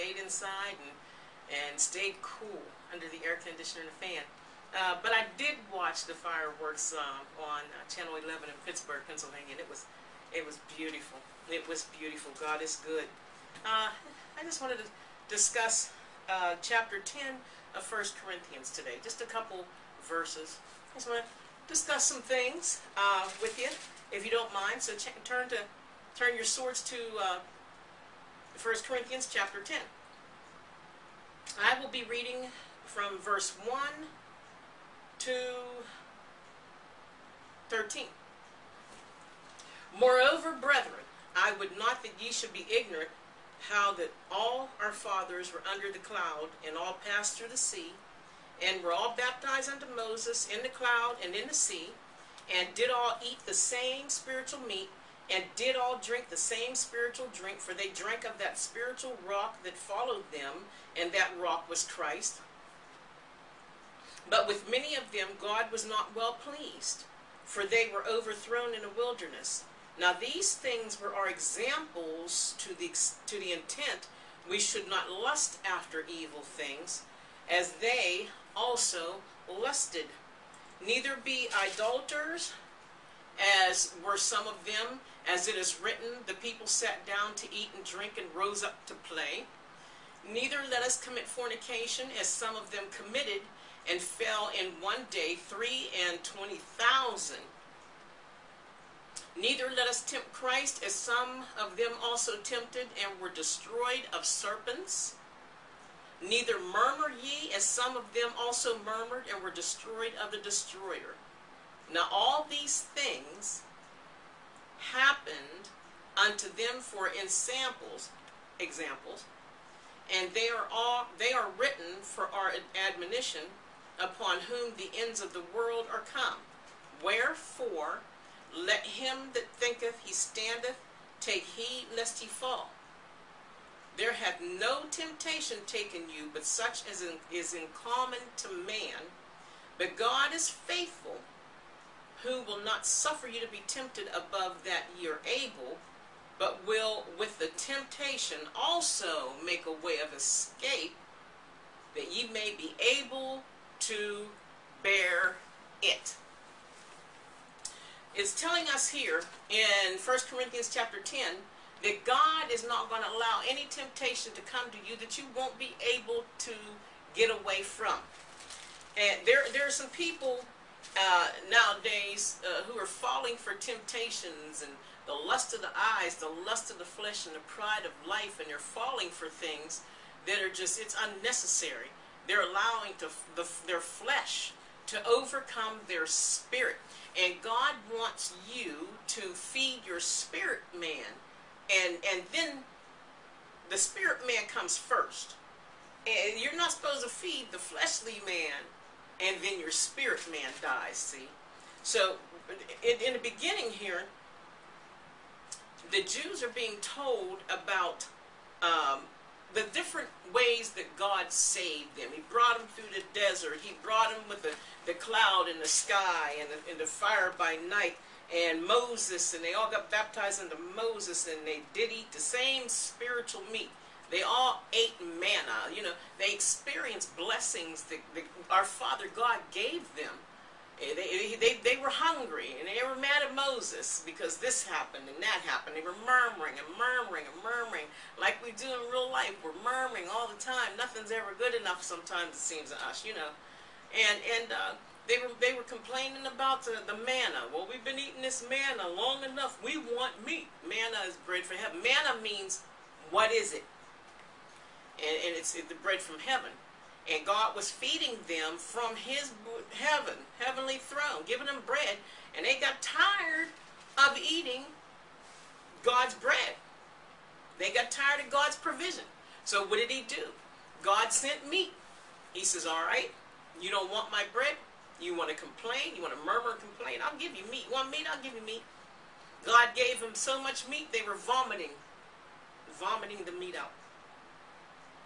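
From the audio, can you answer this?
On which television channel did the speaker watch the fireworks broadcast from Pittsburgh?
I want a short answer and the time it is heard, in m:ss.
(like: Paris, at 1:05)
Channel 11, at 0:07.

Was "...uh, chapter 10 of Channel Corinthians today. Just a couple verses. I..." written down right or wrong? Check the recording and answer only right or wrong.
wrong.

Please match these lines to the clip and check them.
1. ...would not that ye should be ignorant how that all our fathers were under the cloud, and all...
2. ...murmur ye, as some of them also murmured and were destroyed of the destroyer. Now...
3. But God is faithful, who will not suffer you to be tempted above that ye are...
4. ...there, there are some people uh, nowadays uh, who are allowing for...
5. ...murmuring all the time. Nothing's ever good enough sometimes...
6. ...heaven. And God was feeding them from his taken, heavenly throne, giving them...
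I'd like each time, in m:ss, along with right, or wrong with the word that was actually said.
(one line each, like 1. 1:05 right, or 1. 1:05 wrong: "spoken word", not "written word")
1. 0:41 right
2. 1:46 right
3. 2:19 right
4. 2:49 wrong: "falling", not "allowing"
5. 3:59 right
6. 4:16 wrong: "heaven", not "taken".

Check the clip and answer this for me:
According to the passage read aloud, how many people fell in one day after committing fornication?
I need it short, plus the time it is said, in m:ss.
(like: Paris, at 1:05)
23,000, at 1:35.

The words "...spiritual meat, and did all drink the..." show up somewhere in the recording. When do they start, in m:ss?
0:54.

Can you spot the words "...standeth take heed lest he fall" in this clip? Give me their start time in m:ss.
2:10.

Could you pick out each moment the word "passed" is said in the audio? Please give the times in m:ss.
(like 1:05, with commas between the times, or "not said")
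0:47.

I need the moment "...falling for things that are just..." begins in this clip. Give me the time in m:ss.
2:58.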